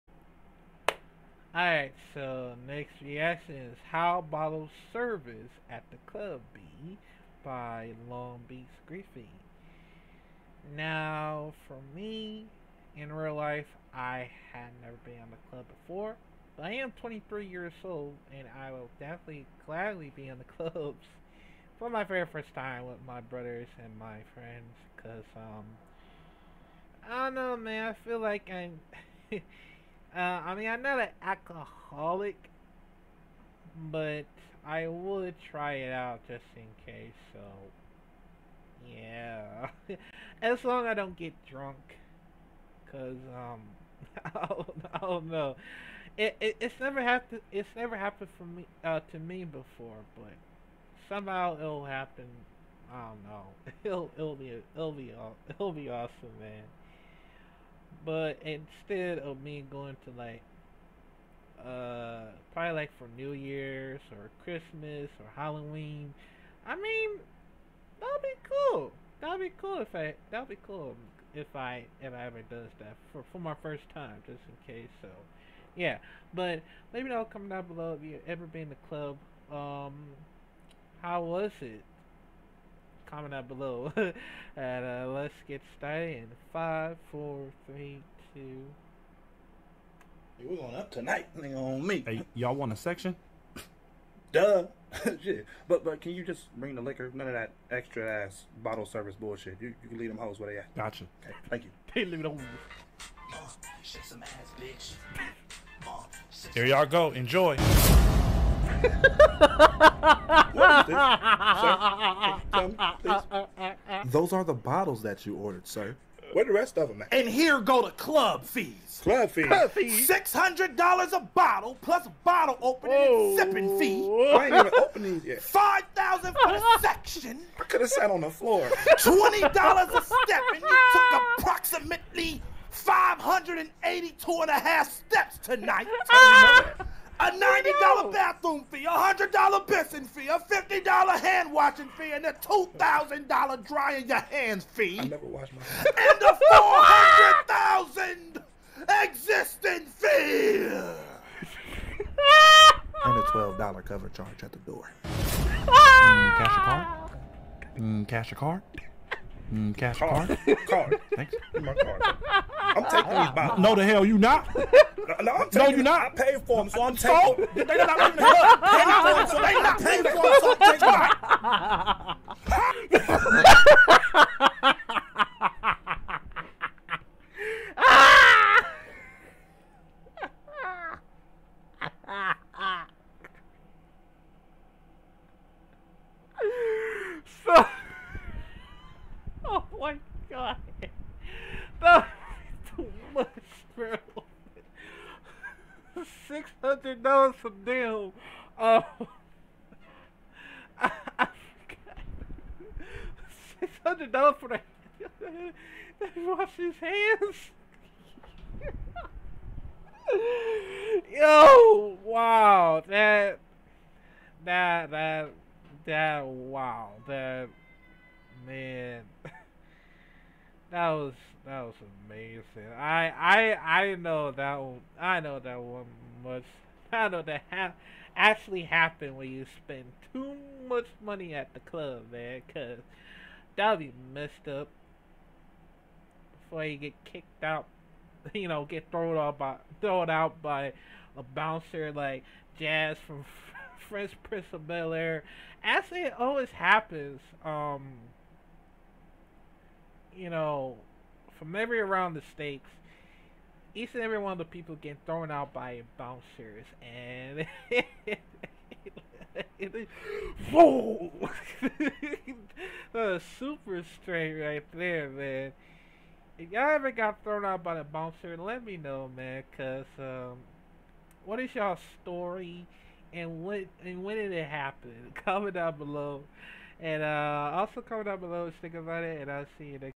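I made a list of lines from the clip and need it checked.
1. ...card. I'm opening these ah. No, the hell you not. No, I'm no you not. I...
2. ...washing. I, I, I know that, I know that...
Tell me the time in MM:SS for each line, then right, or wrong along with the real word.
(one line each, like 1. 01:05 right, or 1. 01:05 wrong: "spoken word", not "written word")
1. 02:41 wrong: "taking", not "opening"
2. 03:42 wrong: "amazing", not "washing".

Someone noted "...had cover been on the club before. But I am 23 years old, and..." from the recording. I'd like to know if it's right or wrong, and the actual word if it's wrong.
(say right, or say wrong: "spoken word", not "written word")
wrong: "never", not "cover".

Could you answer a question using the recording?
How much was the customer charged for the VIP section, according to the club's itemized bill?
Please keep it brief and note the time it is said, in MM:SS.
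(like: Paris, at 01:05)
$5,000, at 02:05.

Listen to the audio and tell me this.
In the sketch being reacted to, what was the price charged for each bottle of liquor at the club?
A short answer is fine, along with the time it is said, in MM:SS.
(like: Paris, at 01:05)
$600, at 02:00.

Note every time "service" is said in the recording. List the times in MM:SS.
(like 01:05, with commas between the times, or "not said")
00:04, 01:38.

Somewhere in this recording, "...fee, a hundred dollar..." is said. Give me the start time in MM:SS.
02:18.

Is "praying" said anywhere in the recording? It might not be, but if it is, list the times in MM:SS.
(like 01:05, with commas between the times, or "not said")
not said.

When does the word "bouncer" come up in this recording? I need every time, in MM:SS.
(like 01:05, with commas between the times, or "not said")
04:01, 04:15, 04:27.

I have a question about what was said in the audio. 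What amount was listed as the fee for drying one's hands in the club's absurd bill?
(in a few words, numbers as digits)
$2,000.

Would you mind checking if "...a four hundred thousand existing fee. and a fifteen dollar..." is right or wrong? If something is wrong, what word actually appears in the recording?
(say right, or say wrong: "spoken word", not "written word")
wrong: "twelve", not "fifteen".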